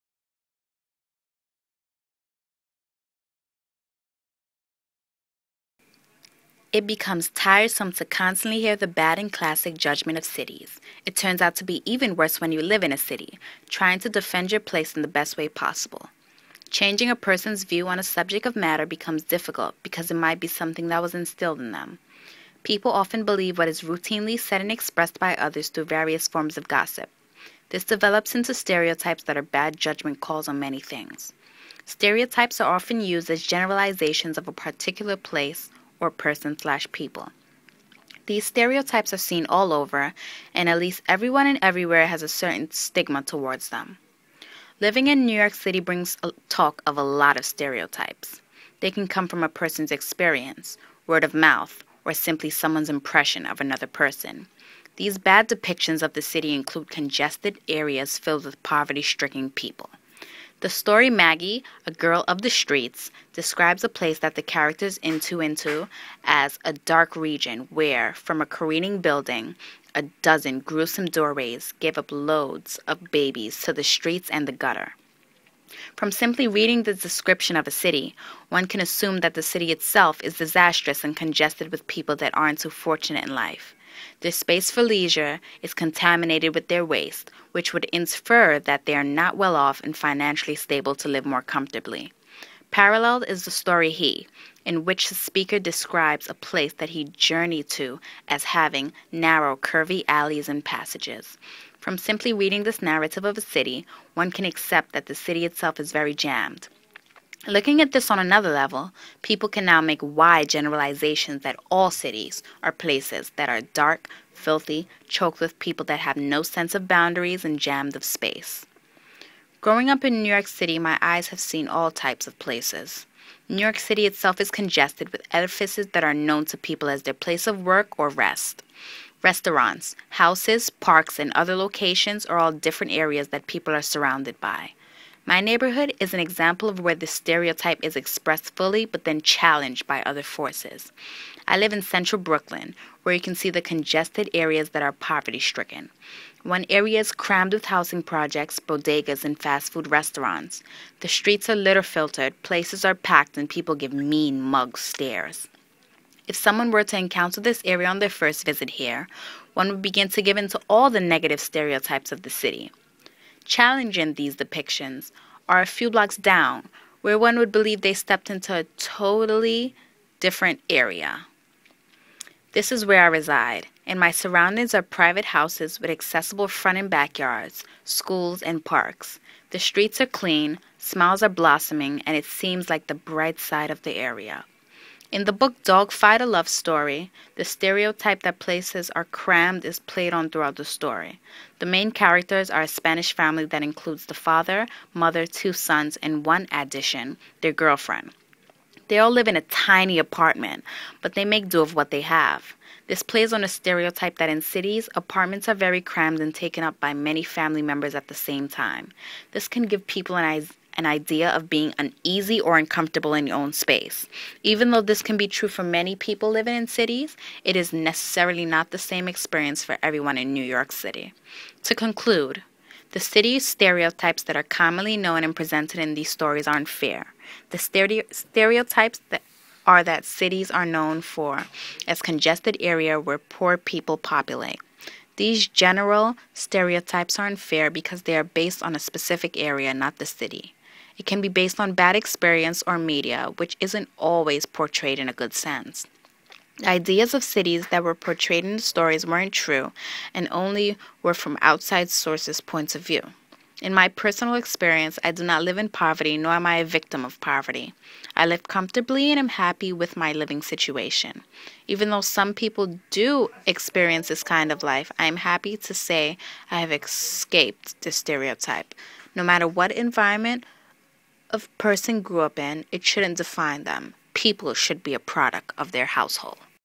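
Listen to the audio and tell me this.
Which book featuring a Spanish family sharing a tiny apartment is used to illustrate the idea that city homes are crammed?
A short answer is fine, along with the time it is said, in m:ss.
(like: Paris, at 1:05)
Dogfight a Love Story, at 3:05.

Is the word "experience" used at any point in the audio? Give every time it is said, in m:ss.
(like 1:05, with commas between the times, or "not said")
0:49, 3:39, 4:01, 4:14, 4:23.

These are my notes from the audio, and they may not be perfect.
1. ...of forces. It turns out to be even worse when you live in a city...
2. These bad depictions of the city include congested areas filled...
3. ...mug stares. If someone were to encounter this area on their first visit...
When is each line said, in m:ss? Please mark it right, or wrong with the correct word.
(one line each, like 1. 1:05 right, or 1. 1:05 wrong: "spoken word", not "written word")
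1. 0:10 wrong: "cities", not "forces"
2. 0:54 right
3. 2:34 right.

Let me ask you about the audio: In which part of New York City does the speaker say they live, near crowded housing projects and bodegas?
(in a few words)
central Brooklyn.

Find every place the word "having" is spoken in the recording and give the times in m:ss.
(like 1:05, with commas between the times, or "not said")
1:38.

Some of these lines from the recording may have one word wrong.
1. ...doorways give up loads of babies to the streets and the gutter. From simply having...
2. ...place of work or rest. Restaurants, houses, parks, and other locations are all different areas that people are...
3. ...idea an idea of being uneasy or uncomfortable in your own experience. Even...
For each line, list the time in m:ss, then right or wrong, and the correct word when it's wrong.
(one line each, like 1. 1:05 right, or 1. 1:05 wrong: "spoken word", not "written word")
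1. 1:11 wrong: "reading", not "having"
2. 2:07 right
3. 3:30 wrong: "space", not "experience".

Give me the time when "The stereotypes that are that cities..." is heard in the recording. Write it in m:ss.
3:47.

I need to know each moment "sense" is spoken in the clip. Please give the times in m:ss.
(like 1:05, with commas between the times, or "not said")
1:56, 4:05.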